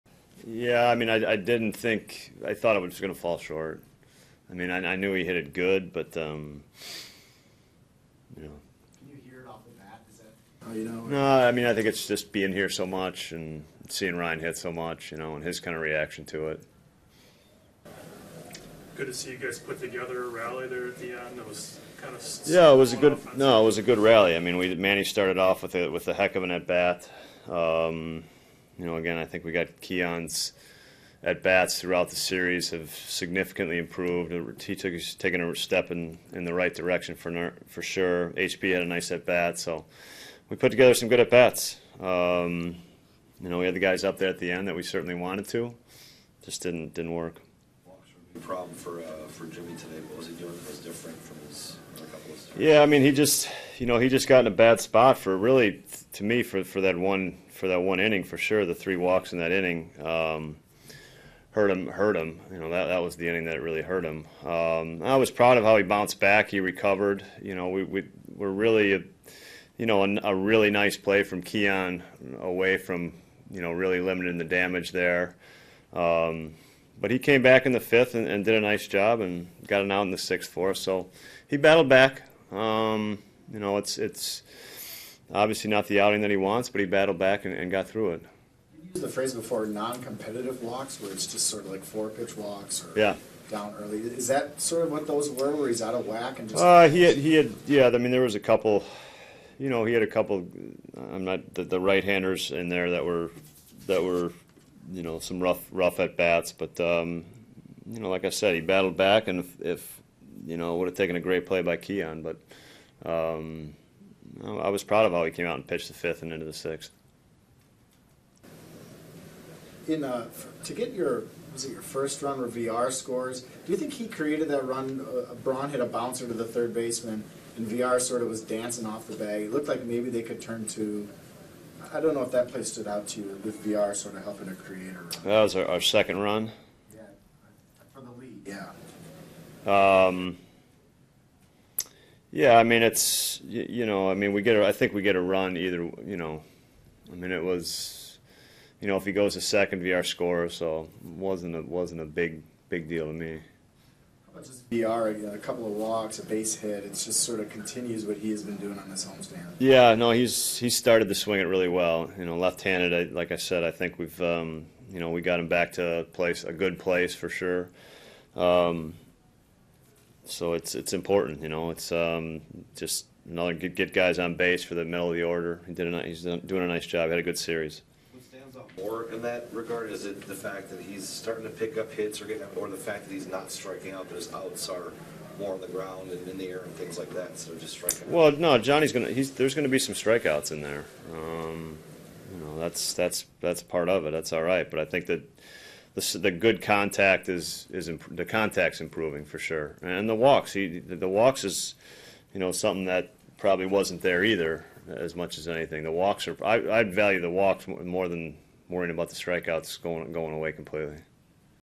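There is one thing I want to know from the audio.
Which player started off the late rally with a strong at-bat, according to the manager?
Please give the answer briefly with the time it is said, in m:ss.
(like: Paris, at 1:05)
Manny, at 0:24.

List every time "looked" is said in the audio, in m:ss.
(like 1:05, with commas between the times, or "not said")
2:09.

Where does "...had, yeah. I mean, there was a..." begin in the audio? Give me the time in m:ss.
1:37.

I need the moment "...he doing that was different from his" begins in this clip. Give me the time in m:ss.
0:50.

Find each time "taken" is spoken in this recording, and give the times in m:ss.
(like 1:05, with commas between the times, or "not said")
0:35, 1:50.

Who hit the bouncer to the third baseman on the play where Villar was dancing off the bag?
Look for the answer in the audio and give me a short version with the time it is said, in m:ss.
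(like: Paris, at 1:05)
Braun, at 2:05.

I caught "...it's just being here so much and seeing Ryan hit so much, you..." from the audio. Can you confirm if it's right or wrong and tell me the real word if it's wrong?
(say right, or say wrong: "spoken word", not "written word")
right.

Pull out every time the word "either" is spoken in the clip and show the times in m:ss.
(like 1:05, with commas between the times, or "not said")
2:25, 3:24.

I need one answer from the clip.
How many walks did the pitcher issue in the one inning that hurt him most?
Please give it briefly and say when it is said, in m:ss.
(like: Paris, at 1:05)
3, at 0:58.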